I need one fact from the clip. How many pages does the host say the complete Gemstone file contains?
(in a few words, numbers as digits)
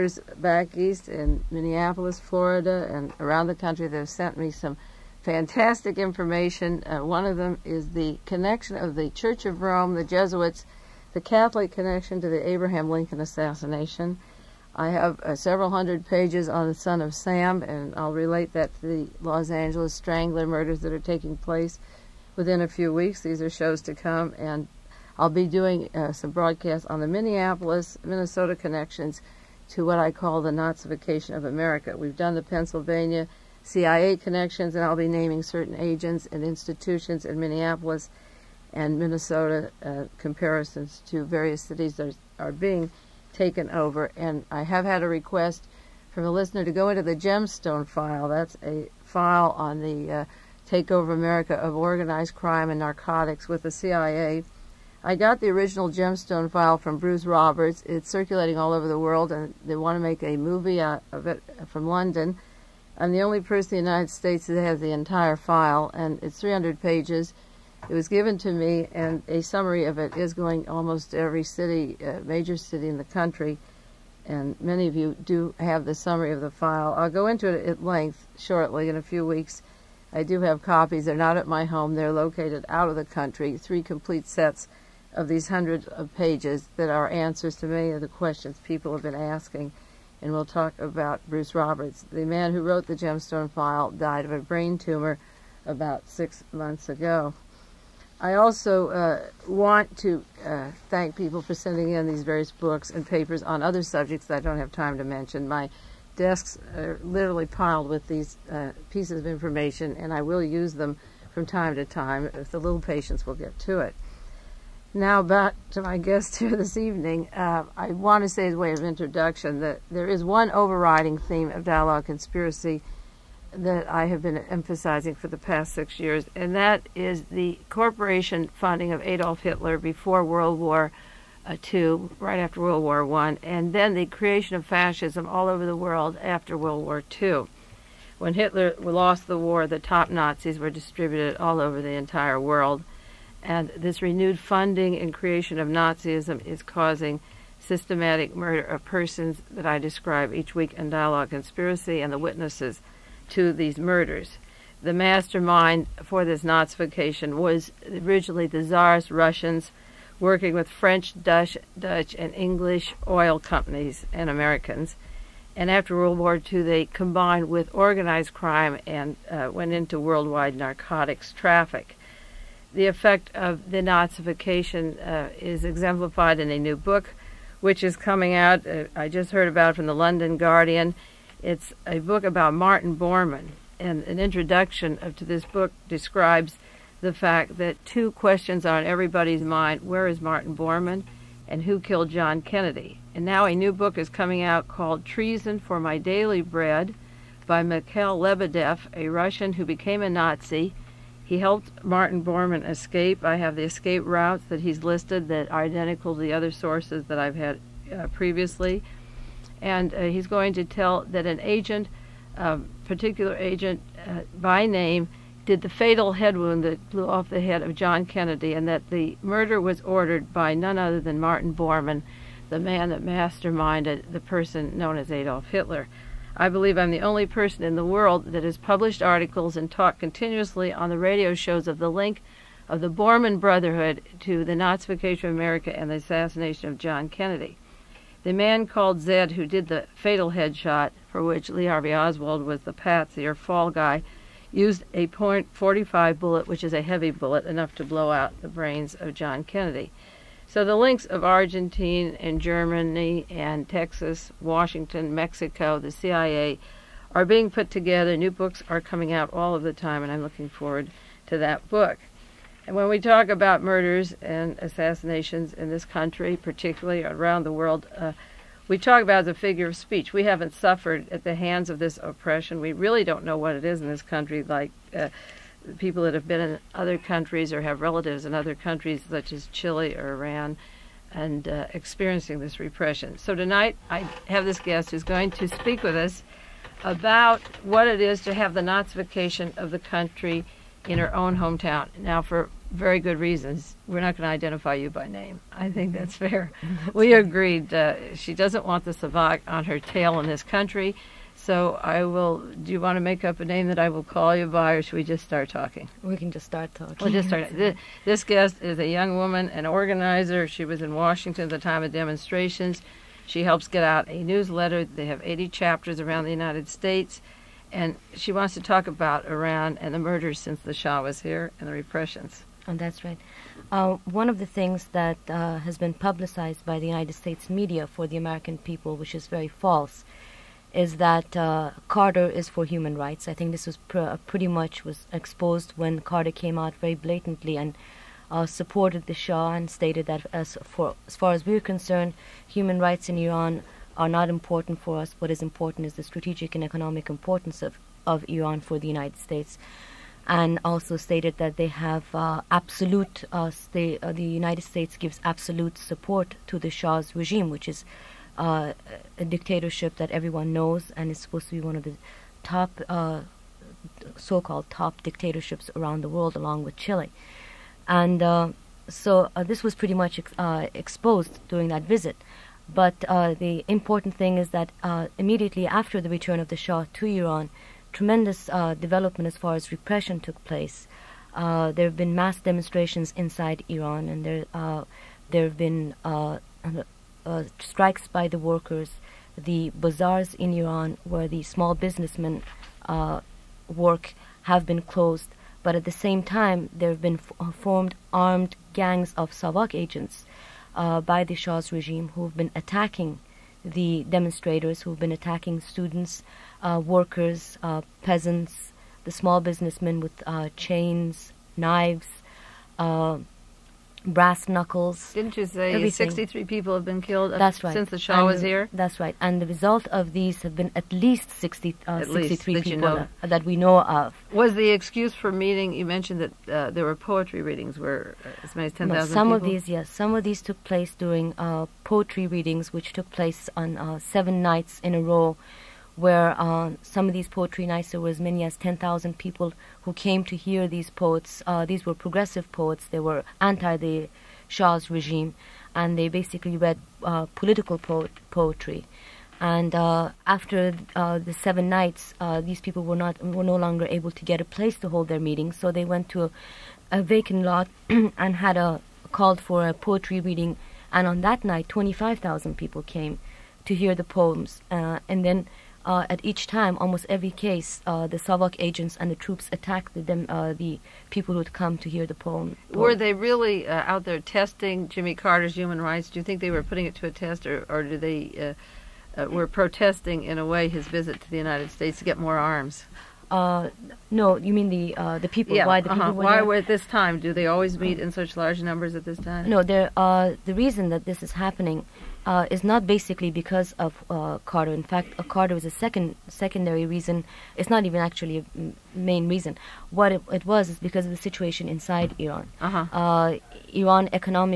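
300.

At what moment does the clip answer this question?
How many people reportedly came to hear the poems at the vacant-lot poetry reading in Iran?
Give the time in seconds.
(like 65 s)
461 s.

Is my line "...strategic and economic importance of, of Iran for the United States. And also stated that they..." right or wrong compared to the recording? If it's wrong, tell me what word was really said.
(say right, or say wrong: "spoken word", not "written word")
right.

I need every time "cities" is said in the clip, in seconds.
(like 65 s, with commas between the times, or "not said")
41 s.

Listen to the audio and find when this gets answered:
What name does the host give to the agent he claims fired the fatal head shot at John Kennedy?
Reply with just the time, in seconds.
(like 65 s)
239 s.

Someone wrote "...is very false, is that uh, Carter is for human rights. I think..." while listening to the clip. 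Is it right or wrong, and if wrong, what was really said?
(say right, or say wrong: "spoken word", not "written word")
right.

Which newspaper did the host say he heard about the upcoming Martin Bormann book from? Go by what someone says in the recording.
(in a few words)
London Guardian.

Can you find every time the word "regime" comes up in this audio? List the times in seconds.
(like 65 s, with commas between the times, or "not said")
357 s, 401 s, 444 s.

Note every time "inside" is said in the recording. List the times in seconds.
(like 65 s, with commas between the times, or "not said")
383 s, 501 s.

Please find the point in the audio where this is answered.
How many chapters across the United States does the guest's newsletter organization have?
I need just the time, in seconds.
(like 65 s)
315 s.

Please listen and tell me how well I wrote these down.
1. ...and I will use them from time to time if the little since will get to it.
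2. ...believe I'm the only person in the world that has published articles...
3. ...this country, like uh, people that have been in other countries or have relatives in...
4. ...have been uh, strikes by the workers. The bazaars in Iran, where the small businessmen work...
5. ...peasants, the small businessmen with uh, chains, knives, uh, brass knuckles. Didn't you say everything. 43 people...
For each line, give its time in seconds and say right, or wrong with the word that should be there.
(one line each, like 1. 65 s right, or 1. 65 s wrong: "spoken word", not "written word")
1. 109 s wrong: "patience", not "since"
2. 226 s right
3. 273 s right
4. 385 s right
5. 408 s wrong: "63", not "43".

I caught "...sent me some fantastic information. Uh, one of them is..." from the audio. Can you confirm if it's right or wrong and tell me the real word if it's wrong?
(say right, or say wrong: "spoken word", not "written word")
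right.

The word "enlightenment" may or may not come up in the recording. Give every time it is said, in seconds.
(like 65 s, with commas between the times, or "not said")
not said.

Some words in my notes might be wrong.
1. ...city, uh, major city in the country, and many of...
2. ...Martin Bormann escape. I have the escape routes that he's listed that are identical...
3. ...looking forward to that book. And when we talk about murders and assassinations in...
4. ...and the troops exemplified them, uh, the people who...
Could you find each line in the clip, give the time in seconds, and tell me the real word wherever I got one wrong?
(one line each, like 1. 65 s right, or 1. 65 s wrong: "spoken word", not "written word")
1. 71 s right
2. 201 s right
3. 260 s right
4. 468 s wrong: "attacked", not "exemplified".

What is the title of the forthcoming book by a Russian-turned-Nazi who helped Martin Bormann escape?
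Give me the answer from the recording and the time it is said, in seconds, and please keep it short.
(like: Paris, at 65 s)
Treason for My Daily Bread, at 195 s.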